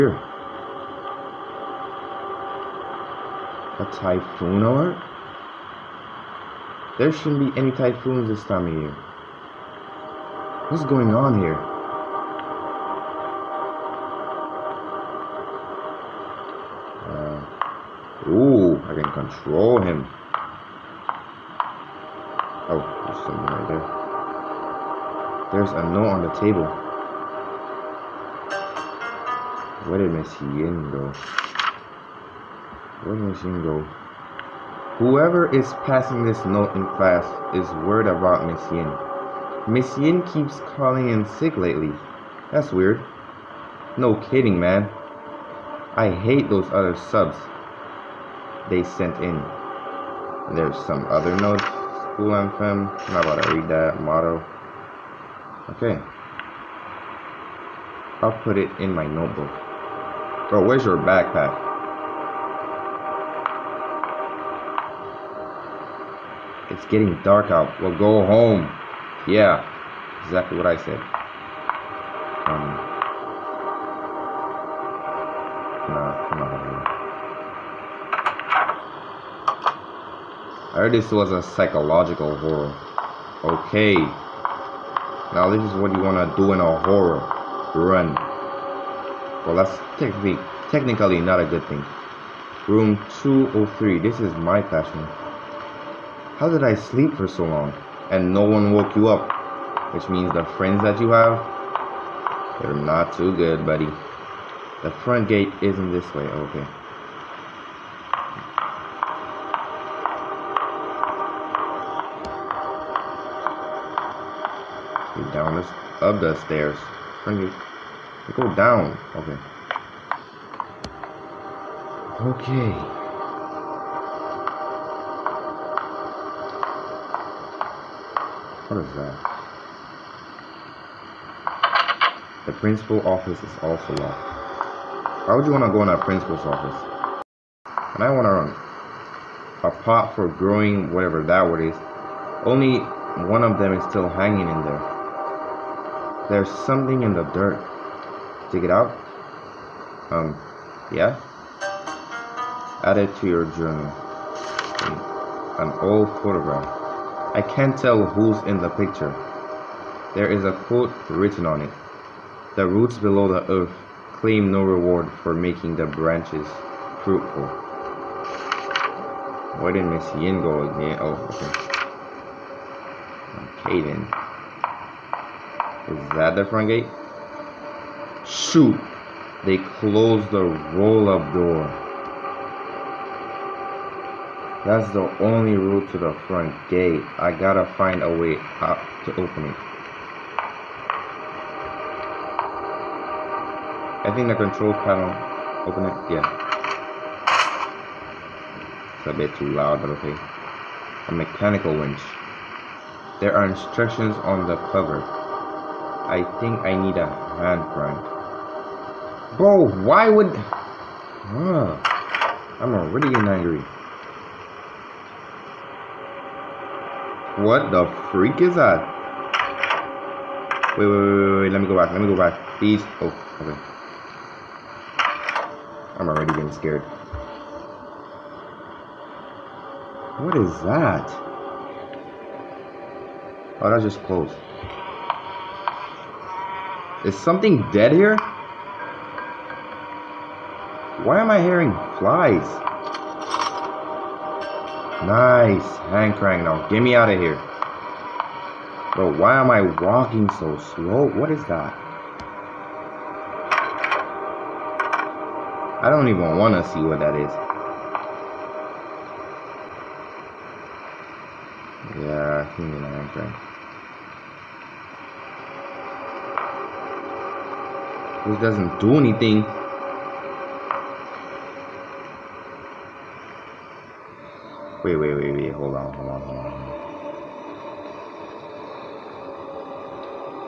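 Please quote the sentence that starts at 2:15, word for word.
Why would you want to go in a principal's office?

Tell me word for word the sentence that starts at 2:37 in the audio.
I can't tell who's in the picture.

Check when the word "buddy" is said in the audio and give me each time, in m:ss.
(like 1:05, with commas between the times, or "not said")
1:43.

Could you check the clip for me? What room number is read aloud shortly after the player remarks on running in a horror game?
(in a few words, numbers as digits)
203.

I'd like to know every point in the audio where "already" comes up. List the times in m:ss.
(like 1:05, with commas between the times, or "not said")
3:32, 3:46.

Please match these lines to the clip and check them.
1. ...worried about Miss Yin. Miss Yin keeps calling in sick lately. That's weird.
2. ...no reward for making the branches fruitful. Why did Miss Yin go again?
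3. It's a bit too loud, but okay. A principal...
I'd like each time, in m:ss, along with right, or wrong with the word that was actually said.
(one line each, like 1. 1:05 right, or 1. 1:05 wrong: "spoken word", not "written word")
1. 0:37 right
2. 2:44 right
3. 3:18 wrong: "mechanical", not "principal".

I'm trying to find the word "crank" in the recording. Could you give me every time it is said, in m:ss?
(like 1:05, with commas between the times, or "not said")
3:27, 4:06.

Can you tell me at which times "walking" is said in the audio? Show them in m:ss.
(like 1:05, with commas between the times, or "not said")
4:09.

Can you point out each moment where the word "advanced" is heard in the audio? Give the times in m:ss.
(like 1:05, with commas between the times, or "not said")
not said.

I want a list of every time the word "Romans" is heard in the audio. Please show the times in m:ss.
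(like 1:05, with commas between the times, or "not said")
not said.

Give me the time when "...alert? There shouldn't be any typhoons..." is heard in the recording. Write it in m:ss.
0:04.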